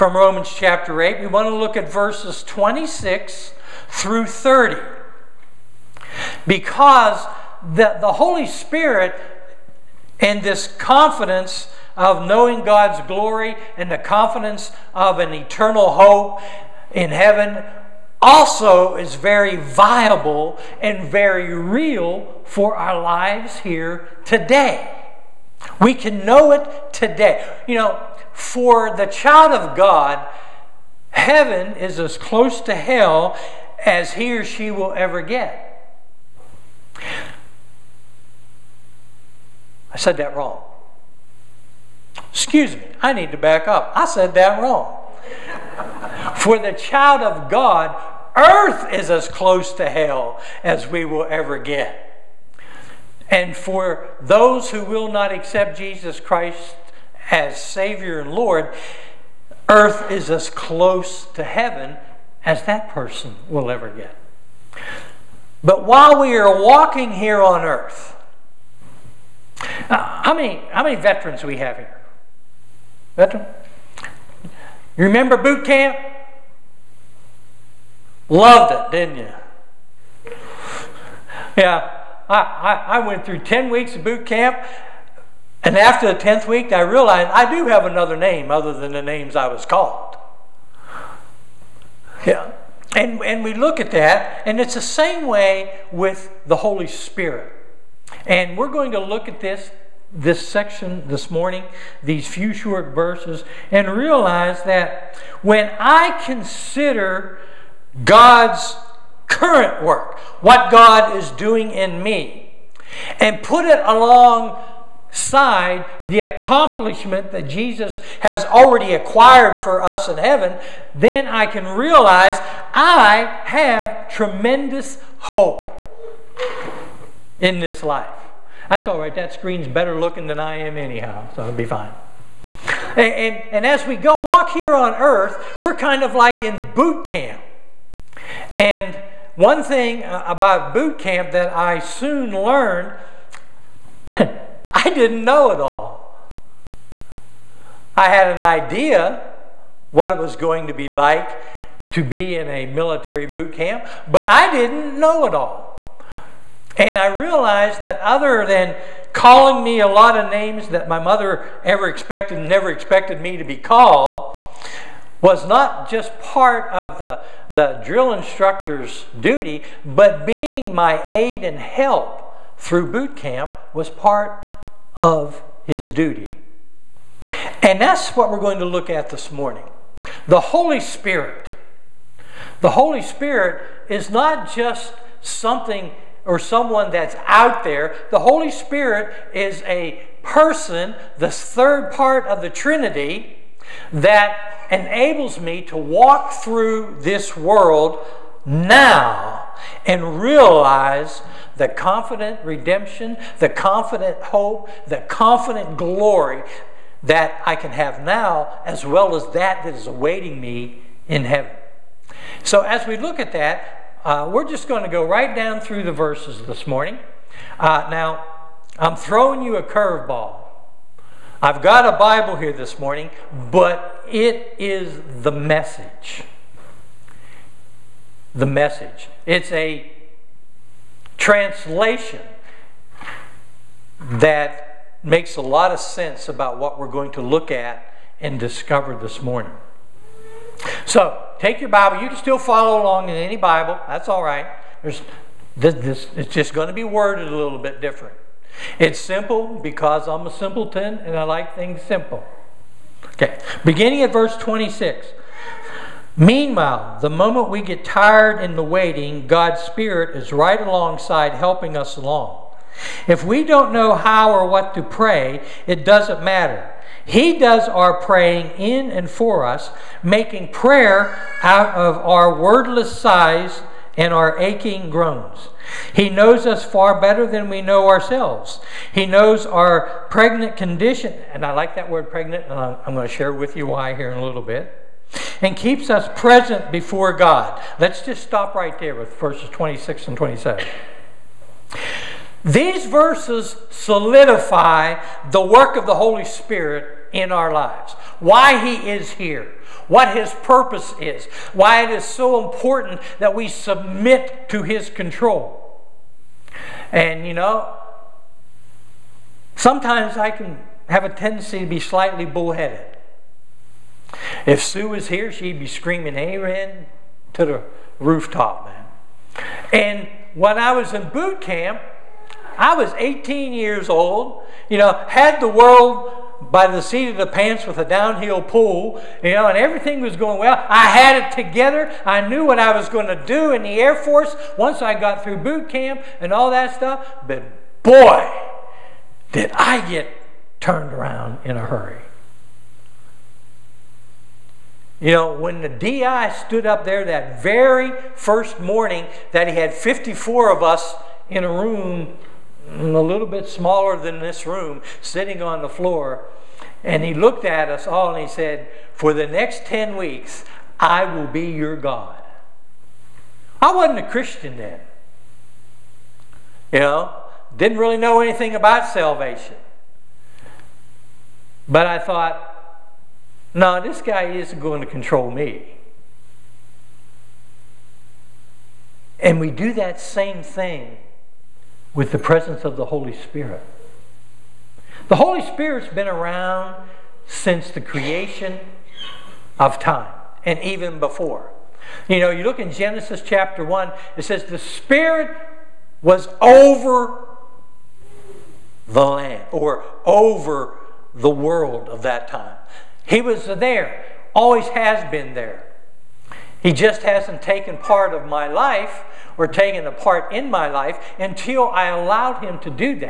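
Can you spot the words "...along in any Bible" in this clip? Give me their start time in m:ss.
4:02.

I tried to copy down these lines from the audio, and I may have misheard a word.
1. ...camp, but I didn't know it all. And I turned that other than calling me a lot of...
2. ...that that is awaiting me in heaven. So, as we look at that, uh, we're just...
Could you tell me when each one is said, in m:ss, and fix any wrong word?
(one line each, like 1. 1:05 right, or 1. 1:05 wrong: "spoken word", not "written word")
1. 2:33 wrong: "realized", not "turned"
2. 3:29 right.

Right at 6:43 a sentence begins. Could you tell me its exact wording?
He was there, always has been there.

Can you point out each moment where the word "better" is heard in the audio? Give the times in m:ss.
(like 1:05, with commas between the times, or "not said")
2:09, 4:36.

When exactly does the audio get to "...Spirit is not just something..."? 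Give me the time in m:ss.
3:03.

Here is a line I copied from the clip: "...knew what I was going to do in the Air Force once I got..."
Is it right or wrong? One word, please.
right.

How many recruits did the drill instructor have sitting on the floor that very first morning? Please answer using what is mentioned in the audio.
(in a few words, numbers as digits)
54.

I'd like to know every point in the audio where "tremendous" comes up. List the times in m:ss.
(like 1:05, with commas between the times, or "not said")
2:04.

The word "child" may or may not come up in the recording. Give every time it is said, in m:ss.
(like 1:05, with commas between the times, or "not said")
0:29, 0:46.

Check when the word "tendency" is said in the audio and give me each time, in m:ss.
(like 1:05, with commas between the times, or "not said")
5:11.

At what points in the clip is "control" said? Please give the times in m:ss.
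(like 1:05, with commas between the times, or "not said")
5:04, 6:14.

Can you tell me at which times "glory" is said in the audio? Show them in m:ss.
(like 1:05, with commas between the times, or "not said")
0:13, 3:25.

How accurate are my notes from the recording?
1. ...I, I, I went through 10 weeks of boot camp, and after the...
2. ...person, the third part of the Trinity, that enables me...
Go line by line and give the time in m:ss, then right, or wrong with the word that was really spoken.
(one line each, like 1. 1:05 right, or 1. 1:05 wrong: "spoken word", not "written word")
1. 1:22 right
2. 3:10 right.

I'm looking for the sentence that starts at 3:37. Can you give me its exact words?
Uh, now, I'm throwing you a curveball.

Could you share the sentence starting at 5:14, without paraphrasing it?
If Sue was here, she'd be screaming amen to the rooftop, man.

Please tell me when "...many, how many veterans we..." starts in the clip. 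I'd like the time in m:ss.
1:10.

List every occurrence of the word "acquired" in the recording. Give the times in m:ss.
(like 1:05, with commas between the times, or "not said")
1:58.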